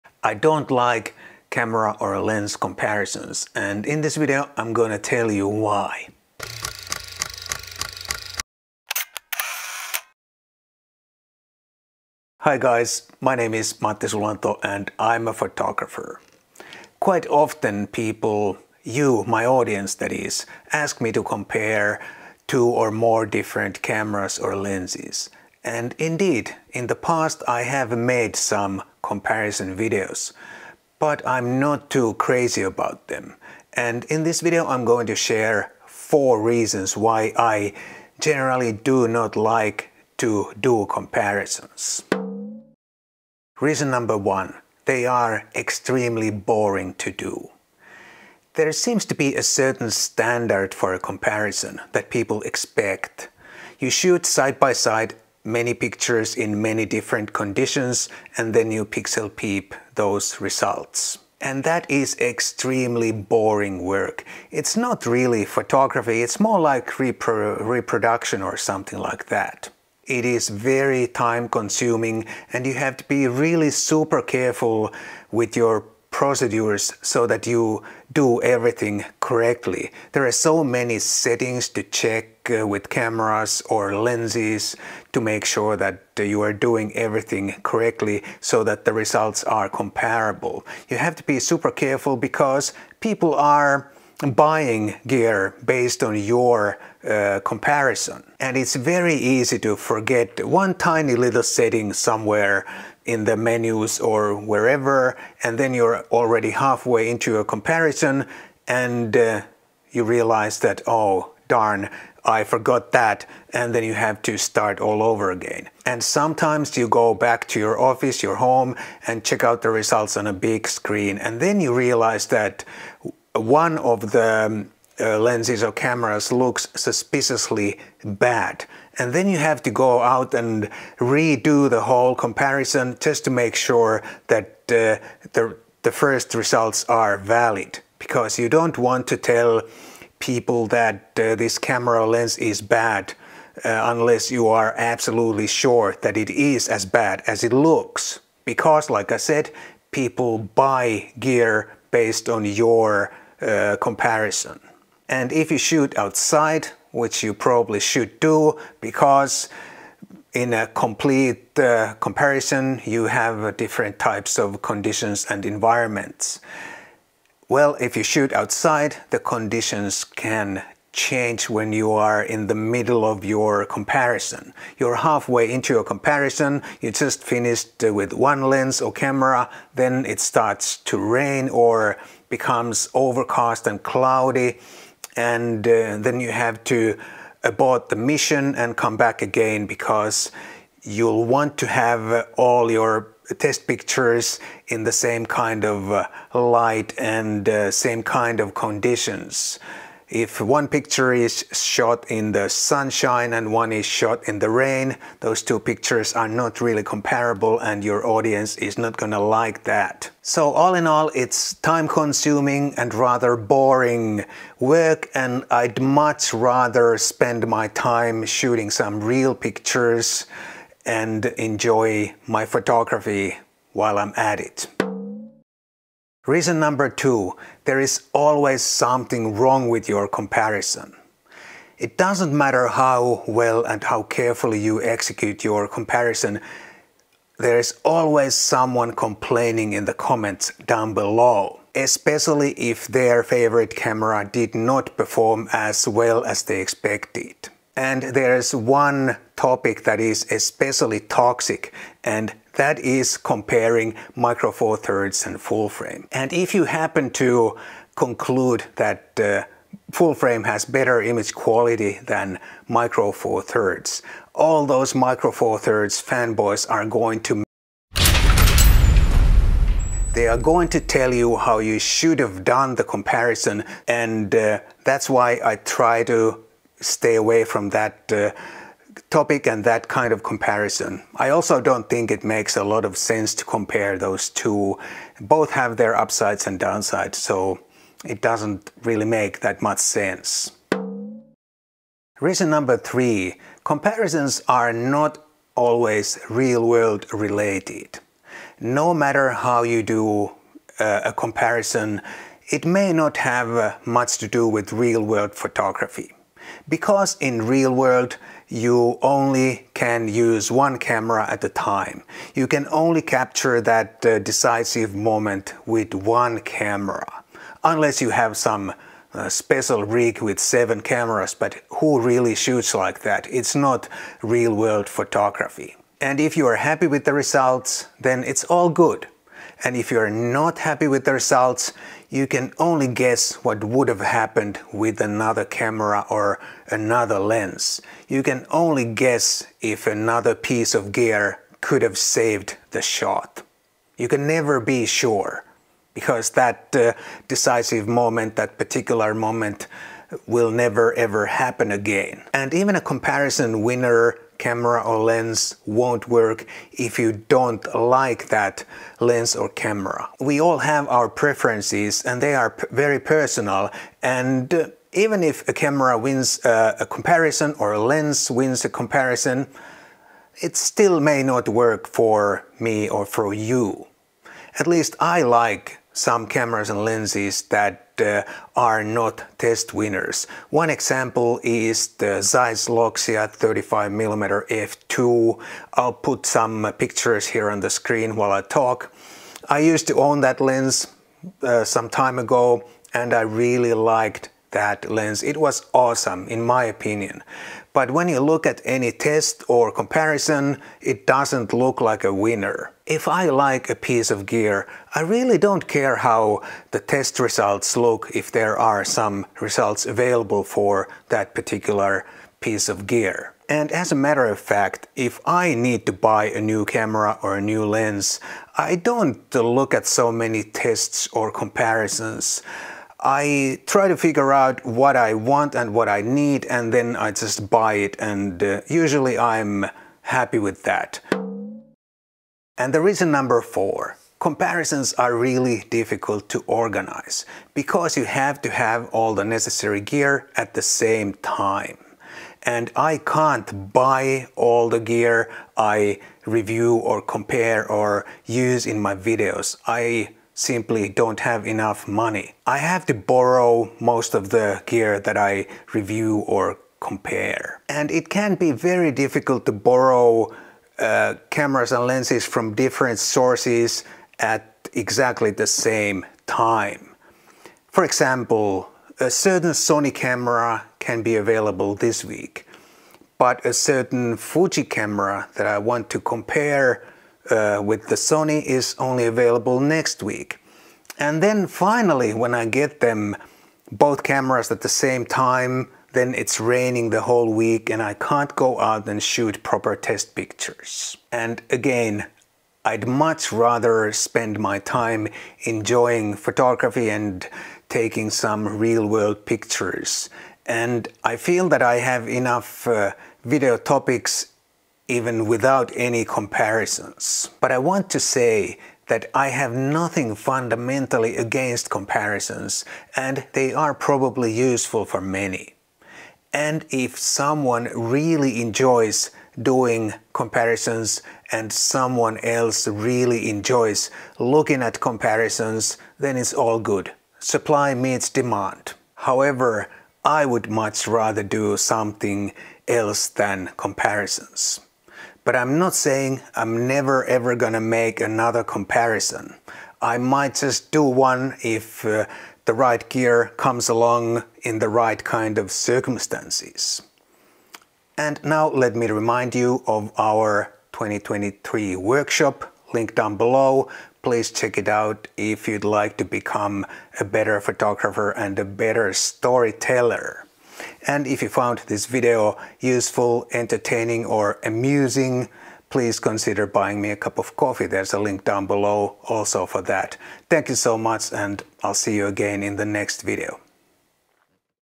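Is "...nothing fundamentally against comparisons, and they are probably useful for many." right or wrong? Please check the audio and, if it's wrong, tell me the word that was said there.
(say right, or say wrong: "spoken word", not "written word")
right.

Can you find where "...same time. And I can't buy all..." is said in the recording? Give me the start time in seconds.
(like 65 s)
440 s.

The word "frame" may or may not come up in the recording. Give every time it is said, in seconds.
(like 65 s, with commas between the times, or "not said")
255 s, 260 s.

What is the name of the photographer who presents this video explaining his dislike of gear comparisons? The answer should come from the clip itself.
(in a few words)
Matti Sulanto.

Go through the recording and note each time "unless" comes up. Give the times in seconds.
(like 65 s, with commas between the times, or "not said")
143 s, 317 s.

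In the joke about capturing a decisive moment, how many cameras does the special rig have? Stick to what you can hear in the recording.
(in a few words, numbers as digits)
7.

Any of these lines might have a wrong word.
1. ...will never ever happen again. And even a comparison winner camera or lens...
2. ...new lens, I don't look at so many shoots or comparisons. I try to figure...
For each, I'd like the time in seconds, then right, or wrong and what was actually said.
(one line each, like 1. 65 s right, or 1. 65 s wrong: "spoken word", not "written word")
1. 350 s right
2. 417 s wrong: "tests", not "shoots".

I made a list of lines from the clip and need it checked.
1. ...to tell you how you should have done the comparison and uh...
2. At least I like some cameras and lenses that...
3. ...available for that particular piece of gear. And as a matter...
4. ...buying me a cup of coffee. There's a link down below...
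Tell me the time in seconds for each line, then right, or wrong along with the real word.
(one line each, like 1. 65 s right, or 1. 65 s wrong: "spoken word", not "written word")
1. 270 s right
2. 374 s right
3. 409 s right
4. 566 s right.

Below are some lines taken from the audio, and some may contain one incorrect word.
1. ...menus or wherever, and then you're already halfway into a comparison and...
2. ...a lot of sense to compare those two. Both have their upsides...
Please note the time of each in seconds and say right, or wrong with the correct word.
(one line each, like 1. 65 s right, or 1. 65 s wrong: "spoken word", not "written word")
1. 103 s right
2. 282 s right.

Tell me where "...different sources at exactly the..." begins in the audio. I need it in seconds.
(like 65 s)
462 s.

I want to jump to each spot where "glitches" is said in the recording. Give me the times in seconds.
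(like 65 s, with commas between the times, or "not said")
not said.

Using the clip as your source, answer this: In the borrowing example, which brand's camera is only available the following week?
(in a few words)
Fuji.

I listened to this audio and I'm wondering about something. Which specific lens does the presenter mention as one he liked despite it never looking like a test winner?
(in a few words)
Zeiss Loxia 35mm f2.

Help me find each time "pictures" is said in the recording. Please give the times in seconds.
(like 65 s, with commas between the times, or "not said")
55 s, 193 s, 200 s, 205 s, 219 s, 386 s, 490 s, 499 s.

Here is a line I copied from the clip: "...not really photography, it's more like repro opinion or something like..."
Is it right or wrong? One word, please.
wrong.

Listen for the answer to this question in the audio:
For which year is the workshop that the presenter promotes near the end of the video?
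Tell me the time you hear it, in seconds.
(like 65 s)
550 s.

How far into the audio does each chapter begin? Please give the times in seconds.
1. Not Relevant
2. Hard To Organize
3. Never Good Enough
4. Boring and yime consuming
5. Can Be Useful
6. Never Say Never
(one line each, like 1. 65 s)
1. 290 s
2. 431 s
3. 224 s
4. 42 s
5. 507 s
6. 528 s.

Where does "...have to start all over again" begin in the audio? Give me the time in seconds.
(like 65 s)
113 s.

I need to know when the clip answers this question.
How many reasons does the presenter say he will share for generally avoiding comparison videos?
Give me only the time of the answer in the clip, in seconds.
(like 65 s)
35 s.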